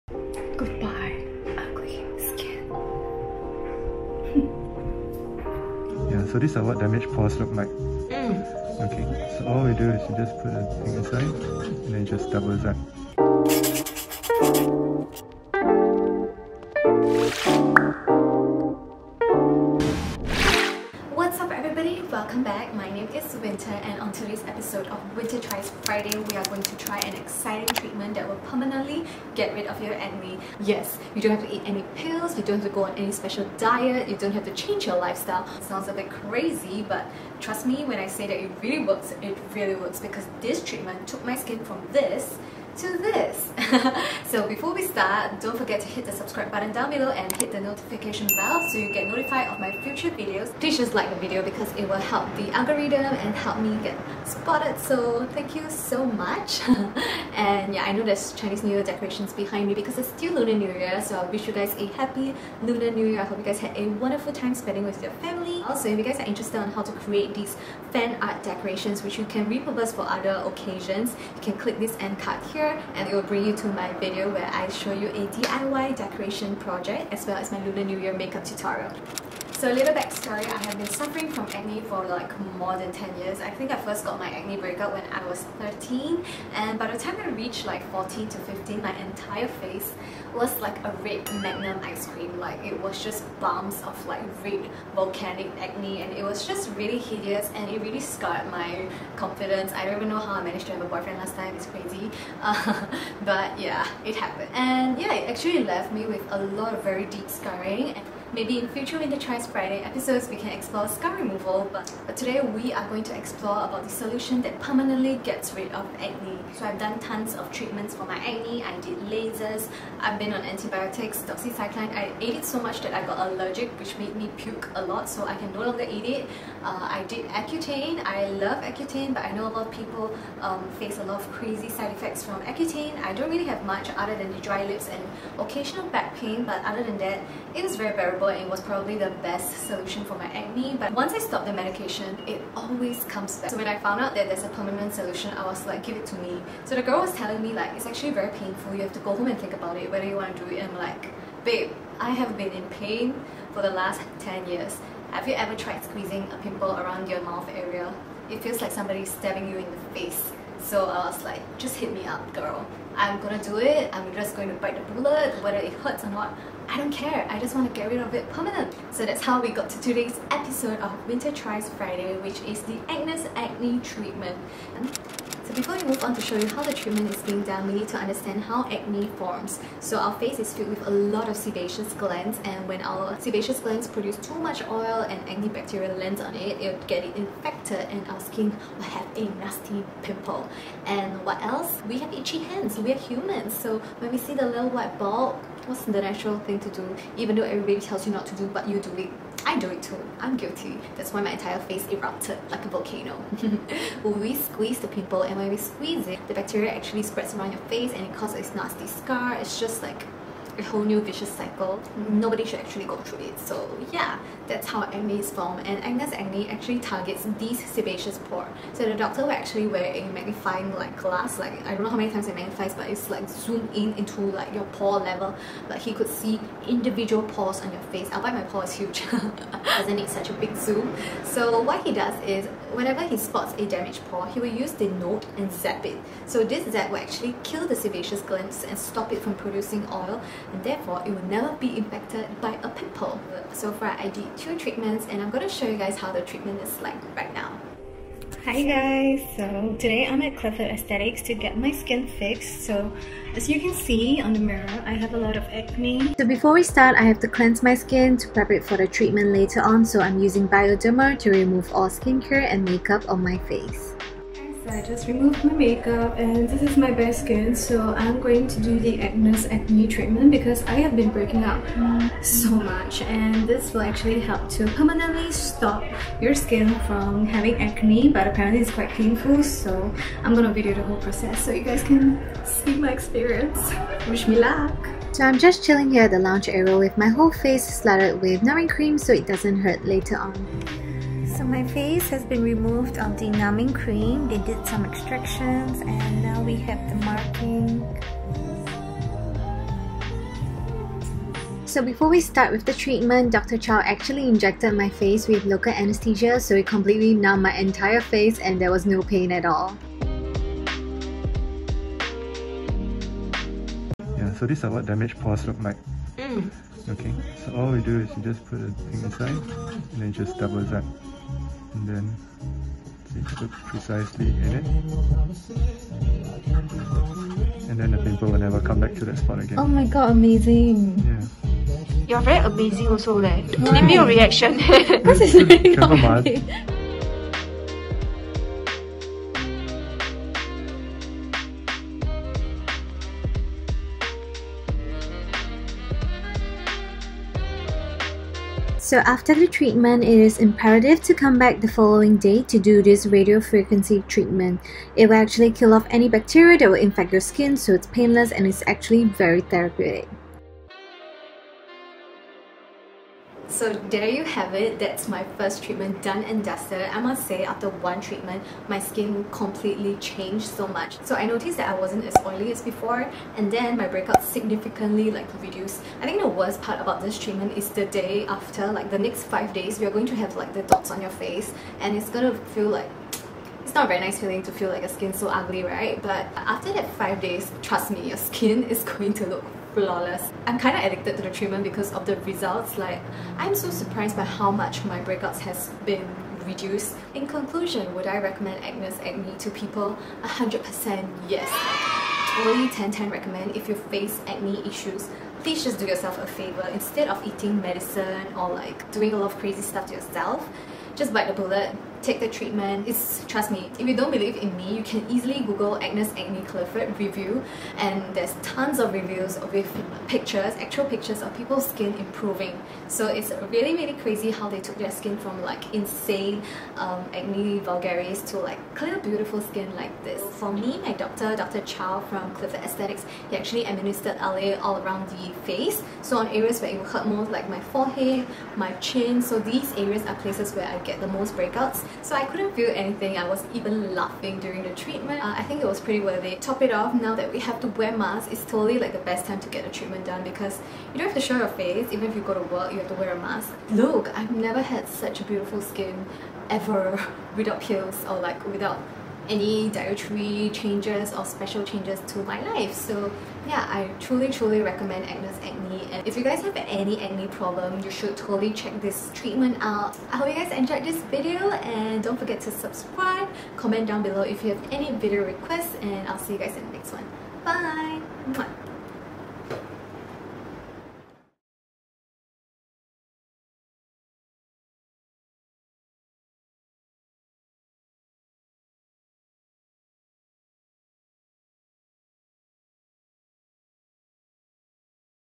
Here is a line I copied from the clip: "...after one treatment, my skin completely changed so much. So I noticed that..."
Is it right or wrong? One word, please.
right.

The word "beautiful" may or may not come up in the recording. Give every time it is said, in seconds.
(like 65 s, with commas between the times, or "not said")
428 s, 455 s.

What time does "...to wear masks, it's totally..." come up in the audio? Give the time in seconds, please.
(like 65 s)
447 s.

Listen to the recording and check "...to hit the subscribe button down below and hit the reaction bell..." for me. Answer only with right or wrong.
wrong.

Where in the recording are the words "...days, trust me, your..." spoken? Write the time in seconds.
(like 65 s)
387 s.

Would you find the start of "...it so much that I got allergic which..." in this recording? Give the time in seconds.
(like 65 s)
122 s.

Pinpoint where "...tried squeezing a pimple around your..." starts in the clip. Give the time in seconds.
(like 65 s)
155 s.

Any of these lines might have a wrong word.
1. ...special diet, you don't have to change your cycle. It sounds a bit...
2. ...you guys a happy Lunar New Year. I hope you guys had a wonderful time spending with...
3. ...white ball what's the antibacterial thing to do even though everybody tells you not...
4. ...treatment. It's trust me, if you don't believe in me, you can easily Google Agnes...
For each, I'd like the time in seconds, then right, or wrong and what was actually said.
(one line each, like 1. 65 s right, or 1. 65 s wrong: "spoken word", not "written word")
1. 33 s wrong: "lifestyle", not "cycle"
2. 61 s right
3. 194 s wrong: "natural", not "antibacterial"
4. 412 s right.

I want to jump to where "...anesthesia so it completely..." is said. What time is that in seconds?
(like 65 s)
305 s.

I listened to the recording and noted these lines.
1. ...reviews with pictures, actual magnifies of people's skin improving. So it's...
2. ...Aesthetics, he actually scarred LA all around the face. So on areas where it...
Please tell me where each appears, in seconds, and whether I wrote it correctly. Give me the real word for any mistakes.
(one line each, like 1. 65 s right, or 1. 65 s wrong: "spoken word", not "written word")
1. 418 s wrong: "pictures", not "magnifies"
2. 432 s wrong: "administered", not "scarred".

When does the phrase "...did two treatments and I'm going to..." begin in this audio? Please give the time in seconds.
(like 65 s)
244 s.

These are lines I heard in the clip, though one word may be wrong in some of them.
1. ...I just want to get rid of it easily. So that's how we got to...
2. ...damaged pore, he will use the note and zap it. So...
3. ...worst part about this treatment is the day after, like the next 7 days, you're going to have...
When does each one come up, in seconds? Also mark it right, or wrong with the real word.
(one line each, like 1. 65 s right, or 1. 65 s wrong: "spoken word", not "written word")
1. 167 s wrong: "permanently", not "easily"
2. 233 s right
3. 376 s wrong: "5", not "7".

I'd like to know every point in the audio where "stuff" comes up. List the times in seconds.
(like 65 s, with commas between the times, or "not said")
409 s.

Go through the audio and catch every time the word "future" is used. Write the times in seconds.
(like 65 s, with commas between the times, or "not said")
49 s, 108 s.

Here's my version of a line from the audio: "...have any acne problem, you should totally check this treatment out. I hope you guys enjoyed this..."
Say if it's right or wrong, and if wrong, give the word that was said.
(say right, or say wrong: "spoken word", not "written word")
right.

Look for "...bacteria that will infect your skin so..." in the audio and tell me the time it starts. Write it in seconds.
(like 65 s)
356 s.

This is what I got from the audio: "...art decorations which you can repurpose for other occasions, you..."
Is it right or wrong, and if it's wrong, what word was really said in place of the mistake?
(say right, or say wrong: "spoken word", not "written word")
right.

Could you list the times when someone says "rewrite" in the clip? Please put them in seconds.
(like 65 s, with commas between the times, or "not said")
not said.